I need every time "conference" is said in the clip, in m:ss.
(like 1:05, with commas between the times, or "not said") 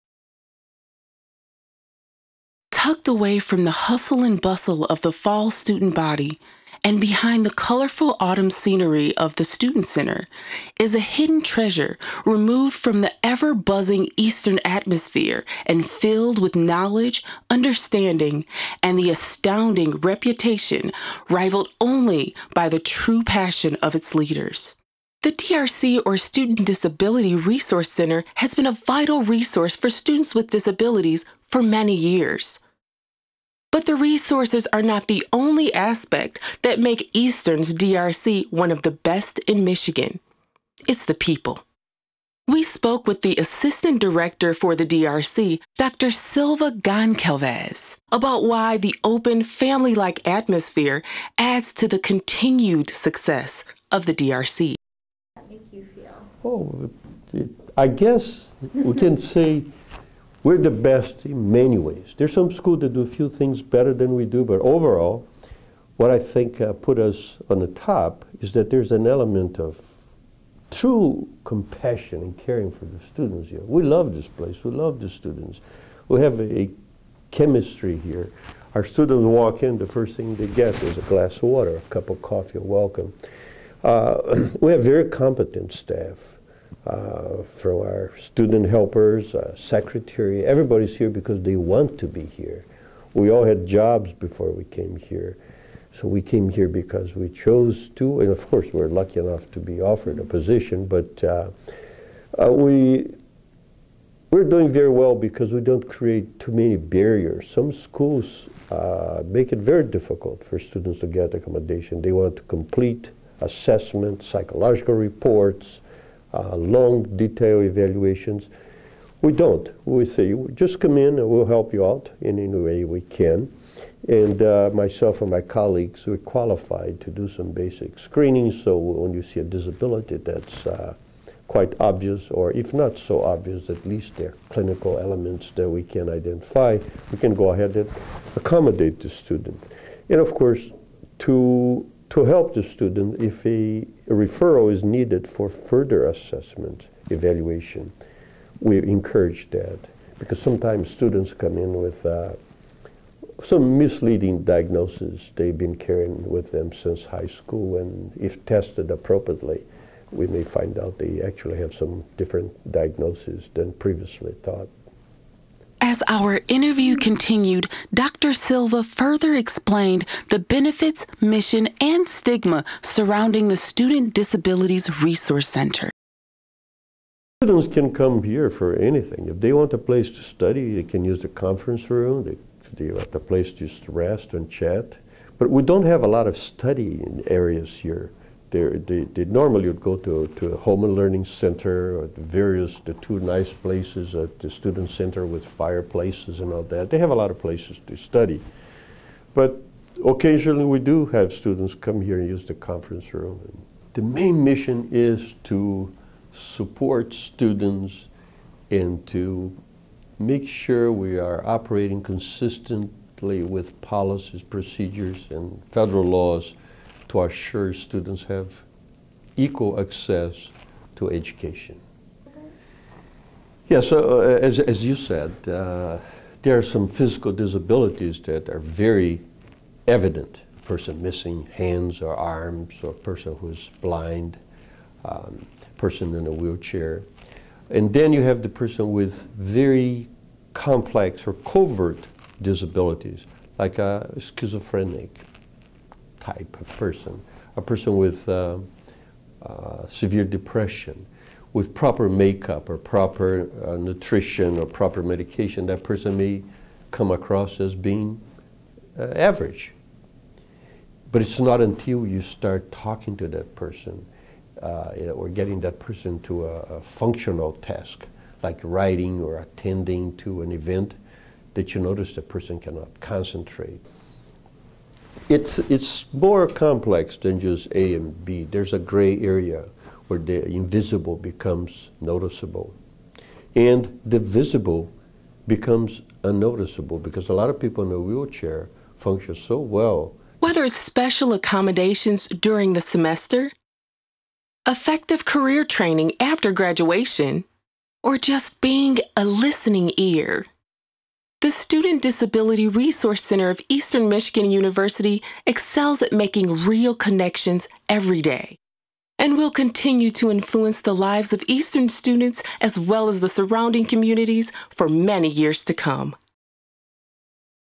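3:01, 3:22.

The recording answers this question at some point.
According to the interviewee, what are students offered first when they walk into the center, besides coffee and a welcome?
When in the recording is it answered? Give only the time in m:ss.
1:20.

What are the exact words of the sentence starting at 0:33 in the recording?
But the resources are not the only aspect that make Eastern's DRC one of the best in Michigan.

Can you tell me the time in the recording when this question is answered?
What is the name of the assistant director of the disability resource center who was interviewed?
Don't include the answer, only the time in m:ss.
0:45.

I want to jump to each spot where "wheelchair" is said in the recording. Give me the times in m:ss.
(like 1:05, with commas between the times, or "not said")
3:56, 4:47.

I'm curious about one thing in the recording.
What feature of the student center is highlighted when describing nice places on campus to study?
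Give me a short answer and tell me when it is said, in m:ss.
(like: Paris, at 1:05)
Fireplaces, at 3:15.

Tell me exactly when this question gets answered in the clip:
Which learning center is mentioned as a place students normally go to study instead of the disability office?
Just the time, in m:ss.
3:10.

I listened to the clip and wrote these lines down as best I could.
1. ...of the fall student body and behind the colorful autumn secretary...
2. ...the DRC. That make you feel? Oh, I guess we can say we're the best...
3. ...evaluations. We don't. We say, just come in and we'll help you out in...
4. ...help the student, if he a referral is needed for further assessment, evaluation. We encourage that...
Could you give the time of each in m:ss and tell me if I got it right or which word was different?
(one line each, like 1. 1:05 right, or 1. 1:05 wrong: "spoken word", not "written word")
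1. 0:04 wrong: "scenery", not "secretary"
2. 0:54 right
3. 1:57 right
4. 2:22 right.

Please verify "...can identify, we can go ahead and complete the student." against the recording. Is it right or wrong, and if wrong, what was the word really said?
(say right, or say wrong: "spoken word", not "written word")
wrong: "accommodate", not "complete".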